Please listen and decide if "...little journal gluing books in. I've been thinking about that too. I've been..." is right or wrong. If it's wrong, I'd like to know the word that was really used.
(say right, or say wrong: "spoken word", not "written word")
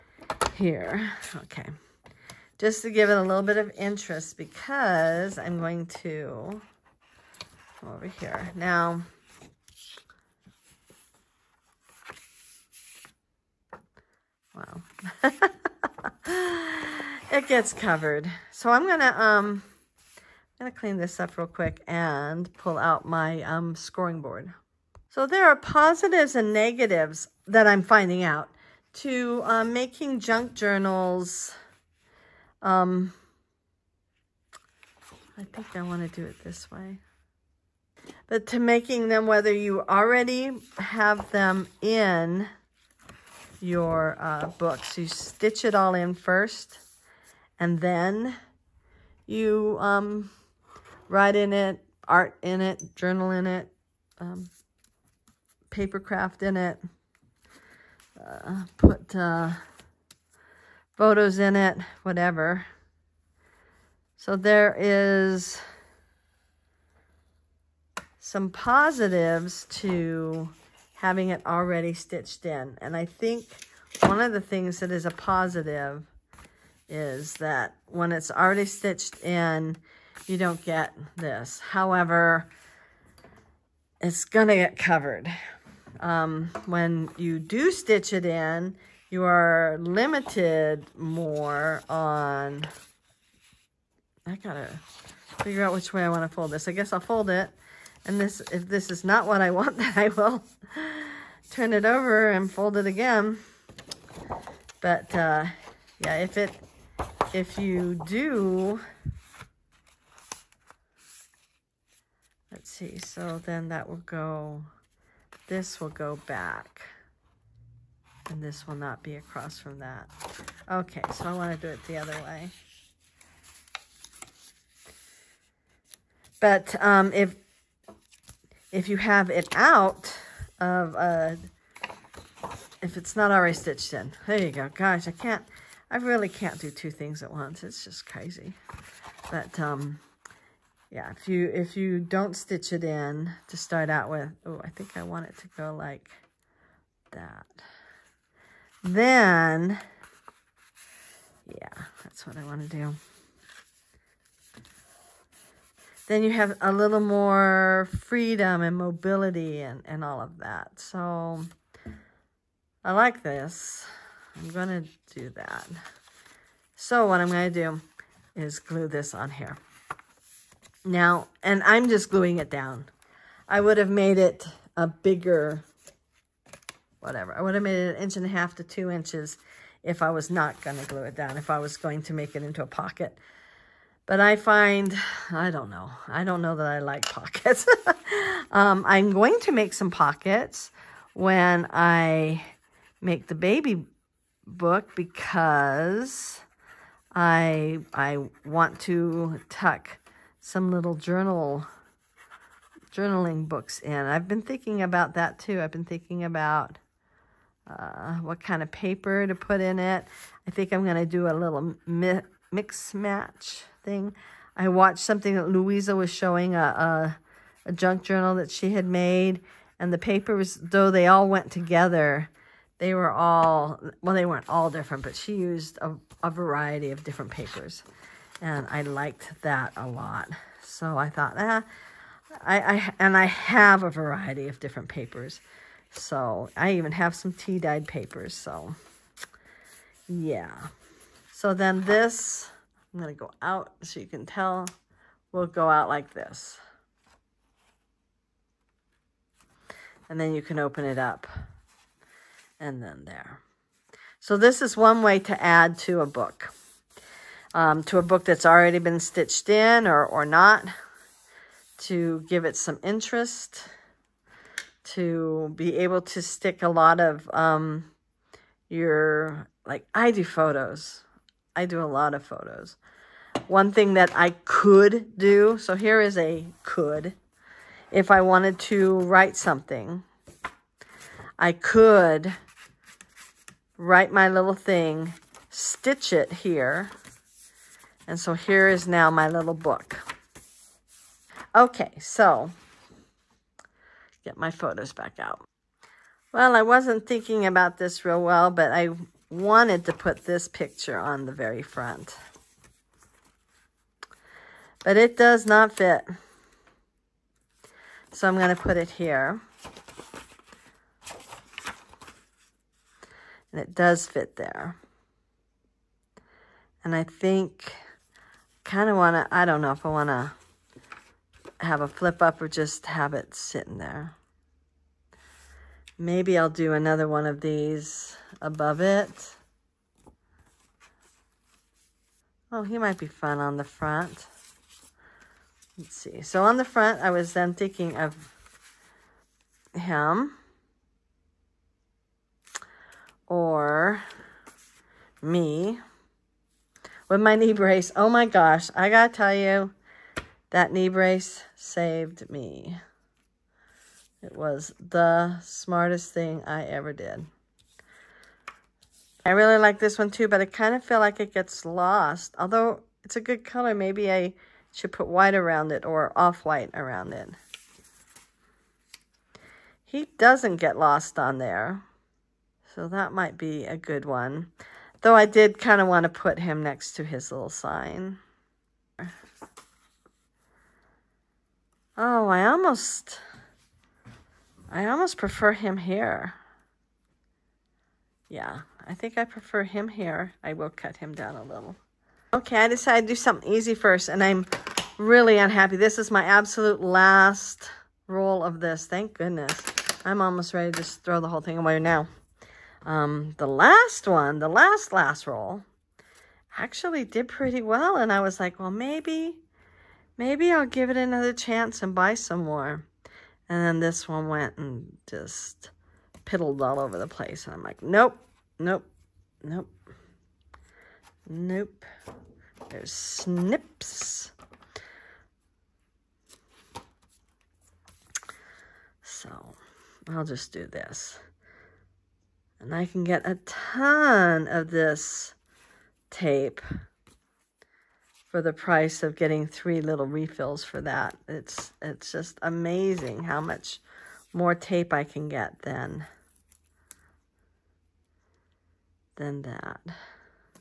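wrong: "journaling", not "gluing".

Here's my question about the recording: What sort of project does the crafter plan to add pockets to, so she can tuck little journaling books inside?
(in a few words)
baby book.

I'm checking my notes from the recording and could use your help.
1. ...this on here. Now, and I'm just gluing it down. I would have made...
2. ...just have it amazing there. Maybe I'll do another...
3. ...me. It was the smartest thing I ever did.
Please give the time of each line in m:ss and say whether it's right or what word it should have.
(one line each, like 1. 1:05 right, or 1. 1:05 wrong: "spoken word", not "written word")
1. 2:48 right
2. 5:22 wrong: "sitting", not "amazing"
3. 5:52 right.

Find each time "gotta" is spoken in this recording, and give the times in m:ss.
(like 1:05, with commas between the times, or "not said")
1:34, 5:48.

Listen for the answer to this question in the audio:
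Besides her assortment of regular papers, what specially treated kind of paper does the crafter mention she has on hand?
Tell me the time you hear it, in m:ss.
3:57.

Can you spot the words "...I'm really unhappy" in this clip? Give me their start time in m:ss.
6:34.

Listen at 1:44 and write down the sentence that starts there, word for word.
But, uh, yeah, if it, if you do, let's see, so then that will go this will go back.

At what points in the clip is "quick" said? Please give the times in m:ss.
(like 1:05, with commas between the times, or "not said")
0:21.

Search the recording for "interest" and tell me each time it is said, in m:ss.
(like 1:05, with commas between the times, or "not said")
0:03, 4:22.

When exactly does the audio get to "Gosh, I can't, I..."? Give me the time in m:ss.
2:14.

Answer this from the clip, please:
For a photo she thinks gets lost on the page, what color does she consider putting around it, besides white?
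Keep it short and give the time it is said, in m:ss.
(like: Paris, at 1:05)
off-white, at 6:06.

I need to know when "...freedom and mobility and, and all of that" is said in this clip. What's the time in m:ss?
2:37.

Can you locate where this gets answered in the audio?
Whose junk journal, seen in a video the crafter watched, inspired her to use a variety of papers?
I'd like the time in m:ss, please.
3:35.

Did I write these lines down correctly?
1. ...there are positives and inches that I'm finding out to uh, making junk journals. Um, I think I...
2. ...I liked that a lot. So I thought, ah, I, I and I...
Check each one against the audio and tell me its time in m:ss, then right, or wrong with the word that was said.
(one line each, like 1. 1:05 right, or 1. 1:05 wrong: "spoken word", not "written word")
1. 0:25 wrong: "negatives", not "inches"
2. 3:48 right.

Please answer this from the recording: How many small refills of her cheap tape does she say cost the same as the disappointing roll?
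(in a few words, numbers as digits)
3.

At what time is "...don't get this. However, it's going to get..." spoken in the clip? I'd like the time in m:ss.
1:20.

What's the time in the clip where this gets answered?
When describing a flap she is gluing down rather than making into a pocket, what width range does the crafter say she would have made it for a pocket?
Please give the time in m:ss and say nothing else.
2:57.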